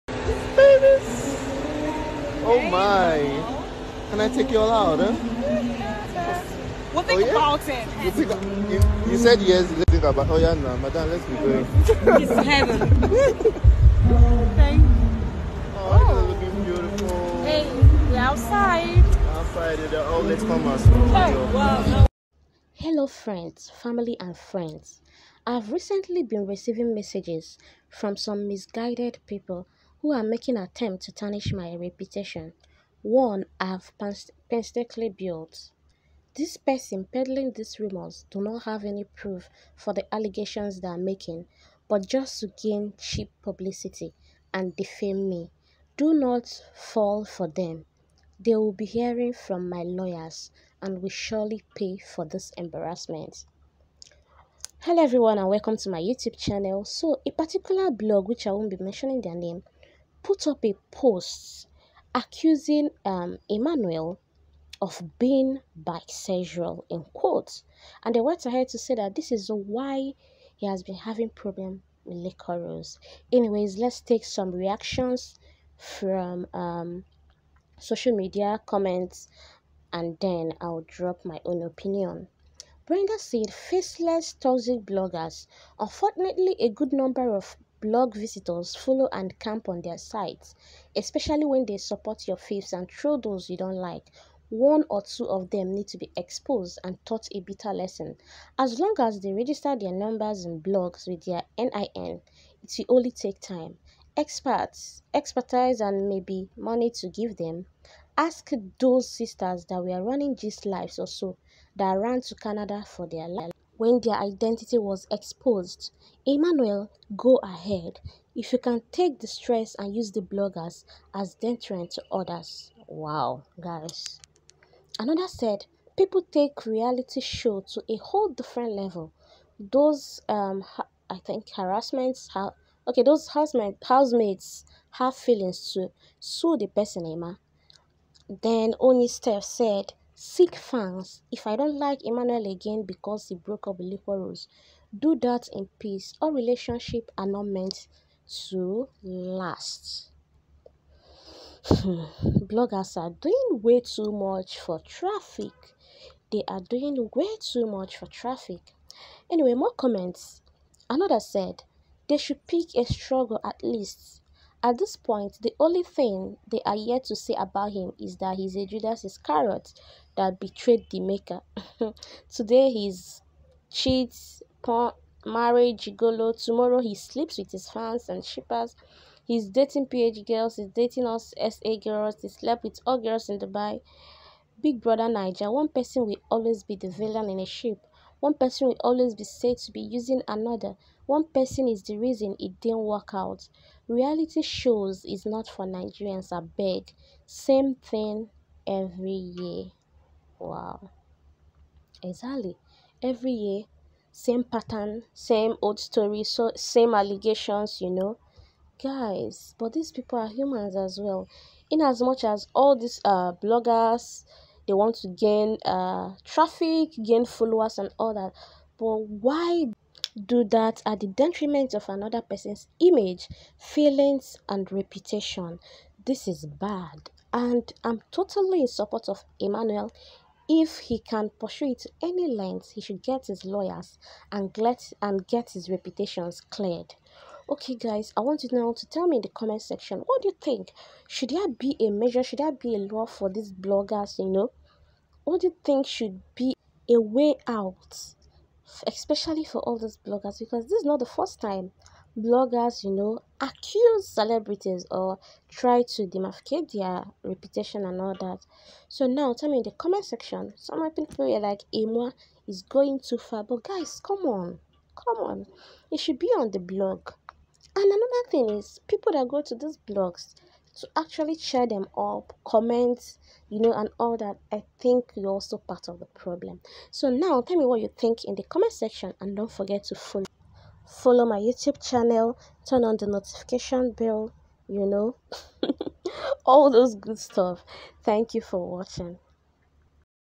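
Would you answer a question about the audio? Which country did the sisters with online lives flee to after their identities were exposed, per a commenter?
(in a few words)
Canada.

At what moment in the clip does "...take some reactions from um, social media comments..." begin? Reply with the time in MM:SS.
01:14.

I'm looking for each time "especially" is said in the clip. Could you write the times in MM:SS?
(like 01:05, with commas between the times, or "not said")
01:30, 04:08.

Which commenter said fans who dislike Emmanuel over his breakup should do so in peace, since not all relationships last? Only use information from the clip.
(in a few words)
Oni Steph.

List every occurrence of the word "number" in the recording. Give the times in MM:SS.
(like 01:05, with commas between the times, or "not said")
01:26, 01:39.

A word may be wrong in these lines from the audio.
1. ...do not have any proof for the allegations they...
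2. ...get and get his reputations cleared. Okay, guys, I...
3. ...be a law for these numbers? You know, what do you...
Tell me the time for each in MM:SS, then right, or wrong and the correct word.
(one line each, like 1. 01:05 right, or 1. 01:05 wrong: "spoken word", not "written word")
1. 00:38 right
2. 03:54 right
3. 04:02 wrong: "bloggers", not "numbers".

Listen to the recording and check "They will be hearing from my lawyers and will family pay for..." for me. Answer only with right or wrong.
wrong.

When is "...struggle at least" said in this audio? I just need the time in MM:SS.
02:42.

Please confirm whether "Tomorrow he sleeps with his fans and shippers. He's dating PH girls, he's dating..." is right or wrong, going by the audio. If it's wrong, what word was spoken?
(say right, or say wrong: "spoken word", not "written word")
right.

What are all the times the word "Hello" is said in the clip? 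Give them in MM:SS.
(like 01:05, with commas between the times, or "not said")
00:22, 00:54.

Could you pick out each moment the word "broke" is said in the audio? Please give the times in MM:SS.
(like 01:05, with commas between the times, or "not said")
02:23.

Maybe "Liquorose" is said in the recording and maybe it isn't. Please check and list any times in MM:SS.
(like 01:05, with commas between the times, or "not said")
01:12, 02:23.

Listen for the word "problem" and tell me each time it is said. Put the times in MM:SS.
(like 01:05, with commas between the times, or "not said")
01:11, 04:36.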